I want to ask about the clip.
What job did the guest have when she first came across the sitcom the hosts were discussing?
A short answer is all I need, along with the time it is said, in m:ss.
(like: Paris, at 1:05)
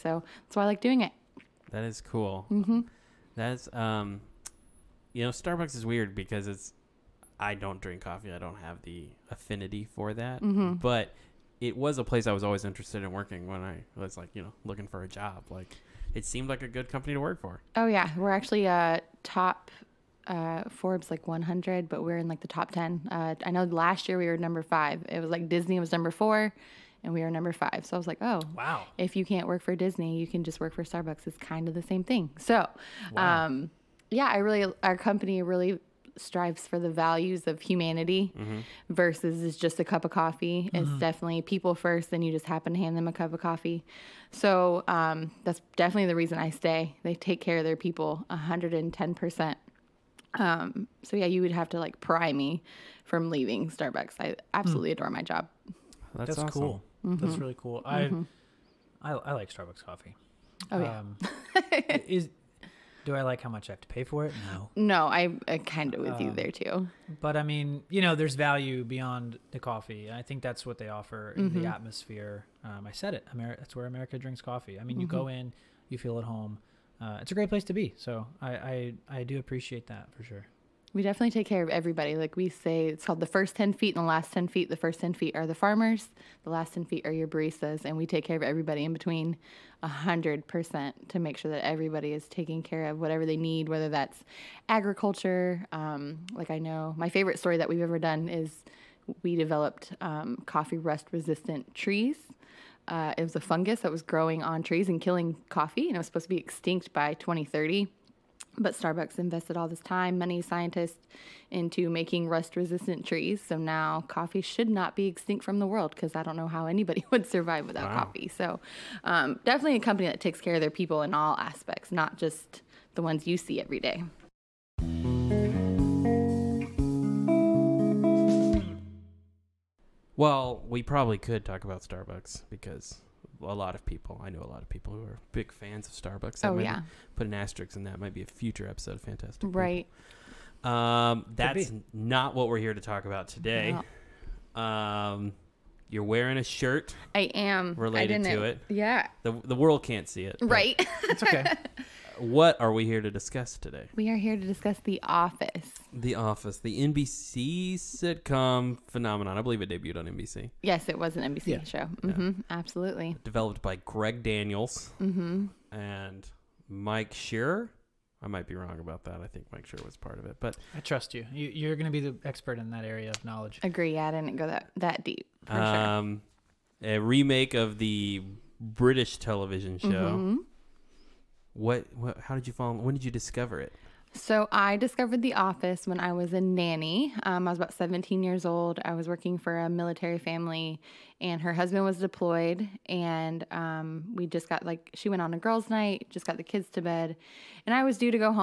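Nanny, at 3:06.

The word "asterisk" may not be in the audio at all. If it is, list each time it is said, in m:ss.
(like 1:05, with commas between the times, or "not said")
2:17.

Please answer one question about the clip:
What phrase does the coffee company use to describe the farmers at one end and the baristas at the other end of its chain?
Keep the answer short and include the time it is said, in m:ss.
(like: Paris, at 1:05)
the first 10 feet and the last 10 feet, at 1:23.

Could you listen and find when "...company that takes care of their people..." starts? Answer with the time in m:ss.
1:59.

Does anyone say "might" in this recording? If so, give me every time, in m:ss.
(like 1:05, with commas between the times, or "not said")
2:17, 2:48.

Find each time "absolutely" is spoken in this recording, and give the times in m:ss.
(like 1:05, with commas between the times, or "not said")
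0:54, 2:42.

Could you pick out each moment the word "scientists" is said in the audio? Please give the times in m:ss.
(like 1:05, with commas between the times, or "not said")
1:50.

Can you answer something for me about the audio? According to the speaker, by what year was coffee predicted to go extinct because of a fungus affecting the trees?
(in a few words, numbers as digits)
2030.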